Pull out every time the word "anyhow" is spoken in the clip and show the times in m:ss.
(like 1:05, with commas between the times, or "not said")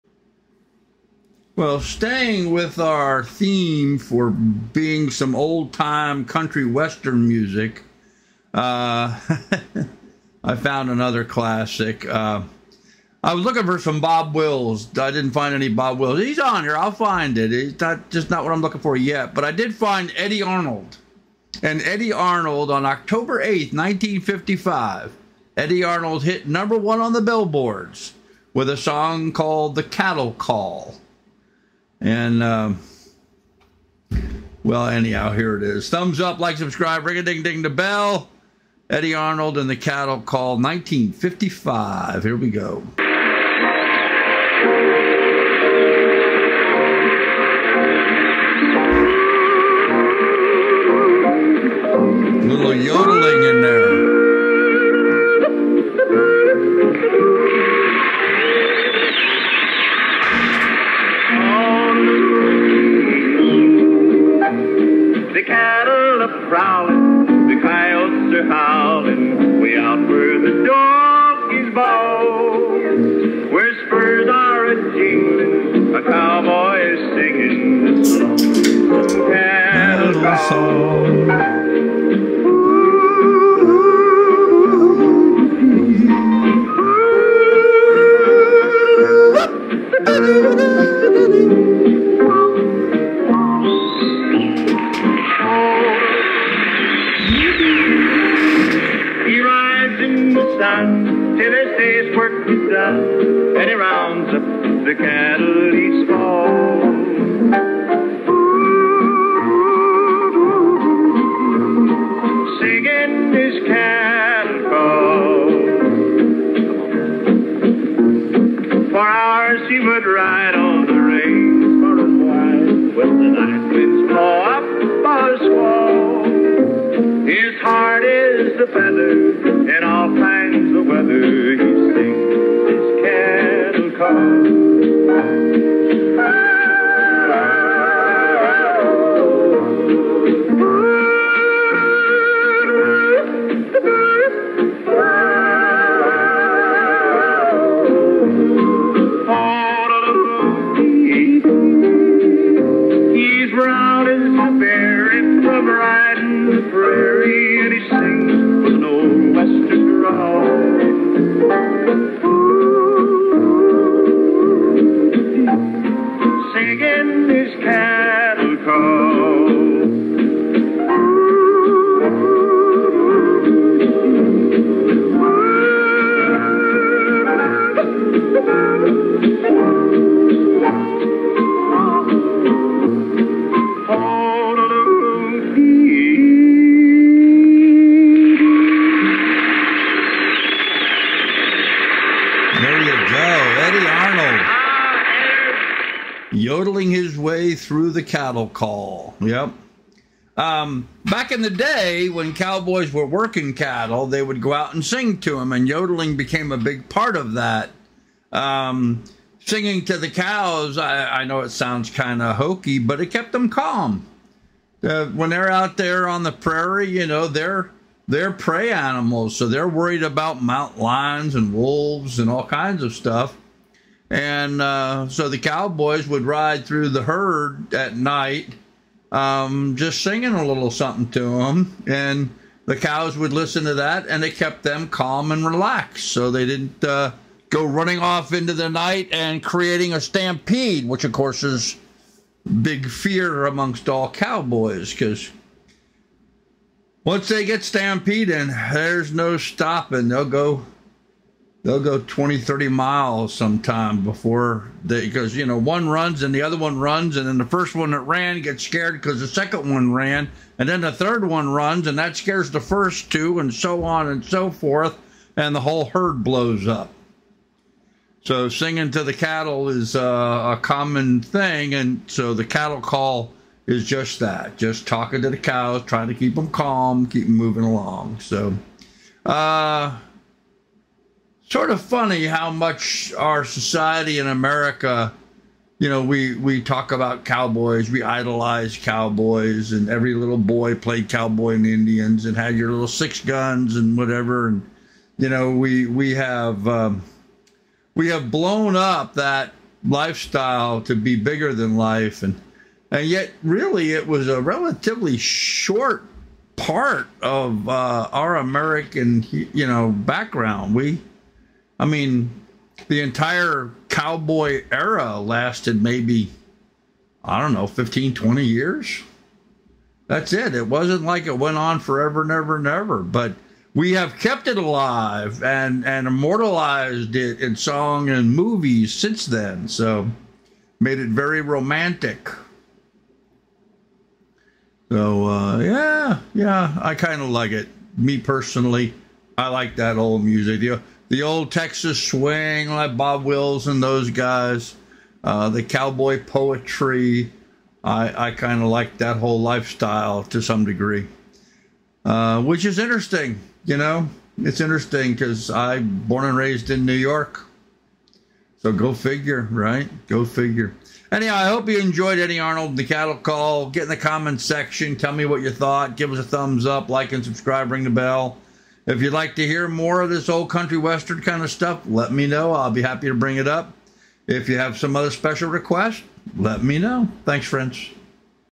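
0:34, 6:01.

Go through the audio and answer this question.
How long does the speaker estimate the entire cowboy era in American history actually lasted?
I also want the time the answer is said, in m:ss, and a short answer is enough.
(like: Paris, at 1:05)
15-20 years, at 5:17.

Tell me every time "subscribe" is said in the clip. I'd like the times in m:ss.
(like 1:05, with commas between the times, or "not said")
0:36, 6:07.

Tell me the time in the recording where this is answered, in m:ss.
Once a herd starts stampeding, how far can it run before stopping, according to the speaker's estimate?
4:11.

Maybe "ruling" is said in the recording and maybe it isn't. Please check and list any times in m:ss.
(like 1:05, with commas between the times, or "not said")
not said.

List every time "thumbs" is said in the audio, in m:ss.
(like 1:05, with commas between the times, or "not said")
0:35, 6:06.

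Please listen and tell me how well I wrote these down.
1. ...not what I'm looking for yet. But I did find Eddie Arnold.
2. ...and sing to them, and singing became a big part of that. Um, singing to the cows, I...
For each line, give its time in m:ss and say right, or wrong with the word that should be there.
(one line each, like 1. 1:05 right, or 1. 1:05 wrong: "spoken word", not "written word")
1. 0:18 right
2. 3:24 wrong: "yodeling", not "singing".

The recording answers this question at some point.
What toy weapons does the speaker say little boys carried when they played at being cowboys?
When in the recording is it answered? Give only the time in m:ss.
4:52.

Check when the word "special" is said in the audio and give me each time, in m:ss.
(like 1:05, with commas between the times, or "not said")
6:15.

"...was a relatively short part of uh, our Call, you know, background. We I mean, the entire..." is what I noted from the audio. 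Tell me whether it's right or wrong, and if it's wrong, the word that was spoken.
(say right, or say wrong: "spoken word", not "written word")
wrong: "American", not "Call".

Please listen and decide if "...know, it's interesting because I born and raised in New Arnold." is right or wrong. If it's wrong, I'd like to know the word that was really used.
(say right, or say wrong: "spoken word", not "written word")
wrong: "York", not "Arnold".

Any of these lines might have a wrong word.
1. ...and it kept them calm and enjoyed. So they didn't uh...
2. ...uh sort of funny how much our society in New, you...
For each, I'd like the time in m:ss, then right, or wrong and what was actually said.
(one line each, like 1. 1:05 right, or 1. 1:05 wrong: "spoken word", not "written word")
1. 3:54 wrong: "relaxed", not "enjoyed"
2. 4:39 wrong: "America", not "New".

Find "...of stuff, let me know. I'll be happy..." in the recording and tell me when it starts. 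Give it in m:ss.
6:11.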